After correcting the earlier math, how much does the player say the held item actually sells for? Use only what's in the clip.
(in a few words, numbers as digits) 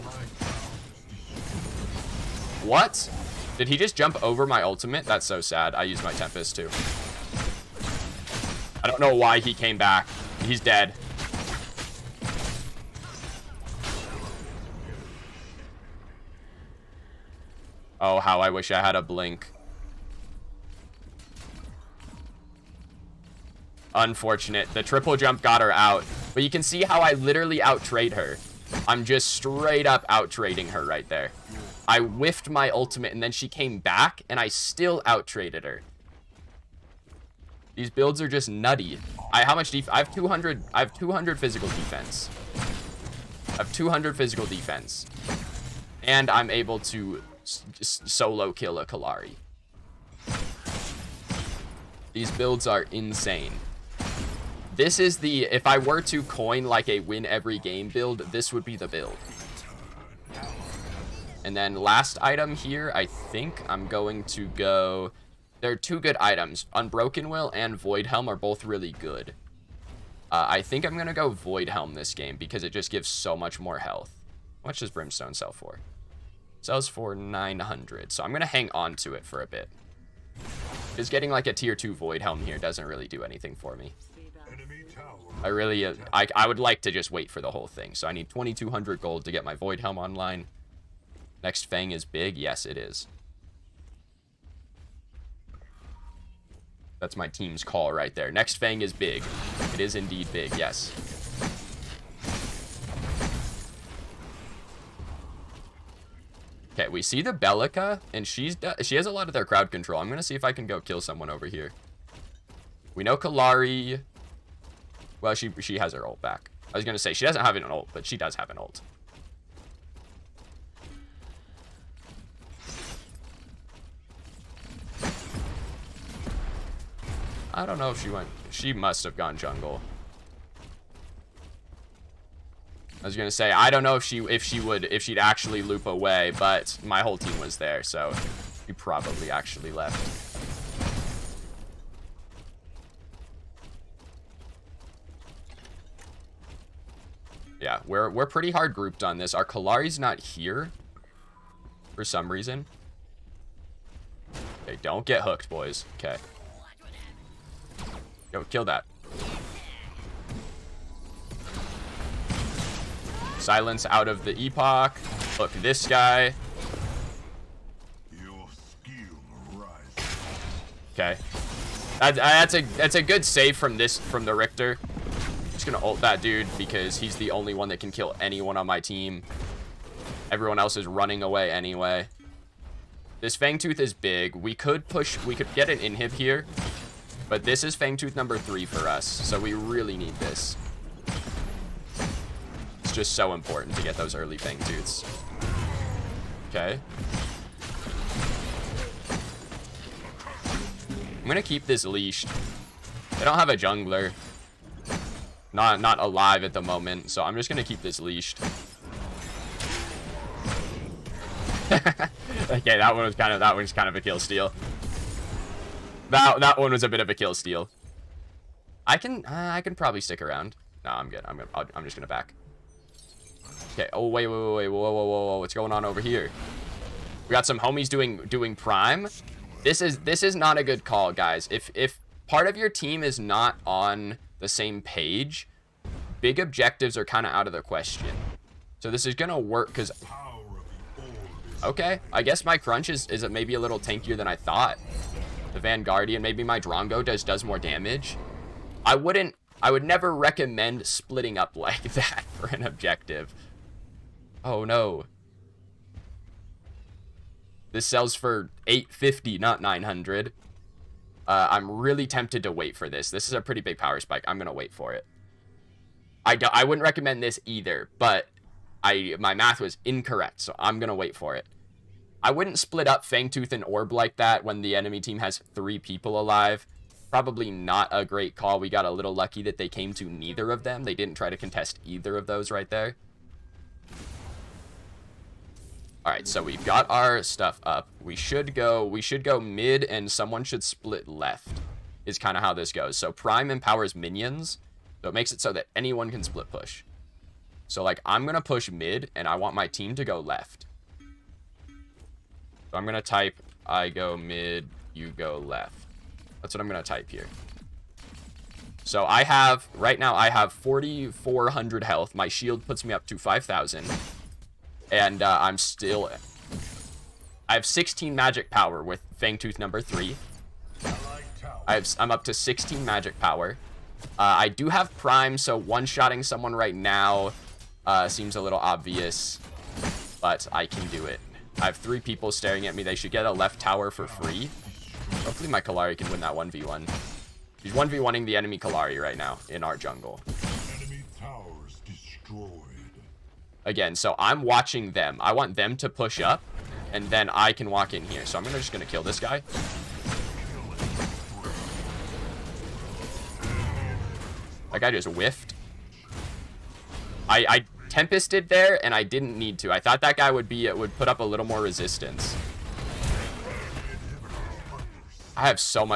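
850.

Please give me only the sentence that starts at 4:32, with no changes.
I wouldn't split up Fangtooth and Orb like that when the enemy team has three people alive.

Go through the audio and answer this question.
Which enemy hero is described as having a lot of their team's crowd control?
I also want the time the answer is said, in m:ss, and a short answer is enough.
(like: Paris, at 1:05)
Belica, at 1:47.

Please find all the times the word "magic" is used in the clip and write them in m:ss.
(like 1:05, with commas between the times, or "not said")
5:18, 5:22.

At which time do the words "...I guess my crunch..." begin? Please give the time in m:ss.
4:02.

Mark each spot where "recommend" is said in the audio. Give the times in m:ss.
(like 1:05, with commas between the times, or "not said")
4:10, 4:26.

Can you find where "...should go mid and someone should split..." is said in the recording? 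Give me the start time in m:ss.
4:49.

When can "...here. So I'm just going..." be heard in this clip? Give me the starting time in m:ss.
5:48.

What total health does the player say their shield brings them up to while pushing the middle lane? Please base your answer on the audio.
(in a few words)
5,000.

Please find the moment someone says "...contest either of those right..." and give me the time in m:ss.
4:41.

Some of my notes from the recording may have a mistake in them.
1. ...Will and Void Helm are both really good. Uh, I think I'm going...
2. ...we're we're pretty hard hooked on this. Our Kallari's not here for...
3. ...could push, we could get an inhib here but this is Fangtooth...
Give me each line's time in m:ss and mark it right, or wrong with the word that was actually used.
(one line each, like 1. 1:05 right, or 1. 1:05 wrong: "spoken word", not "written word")
1. 1:07 right
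2. 2:27 wrong: "grouped", not "hooked"
3. 3:04 right.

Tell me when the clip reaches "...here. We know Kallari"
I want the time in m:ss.
1:51.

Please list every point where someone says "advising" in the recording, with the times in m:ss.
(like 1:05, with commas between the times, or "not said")
not said.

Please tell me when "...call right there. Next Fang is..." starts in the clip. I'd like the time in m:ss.
1:37.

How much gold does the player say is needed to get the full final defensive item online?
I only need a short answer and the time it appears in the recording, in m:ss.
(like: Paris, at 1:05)
2,200, at 1:28.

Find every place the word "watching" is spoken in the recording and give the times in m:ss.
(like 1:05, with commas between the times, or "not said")
5:44.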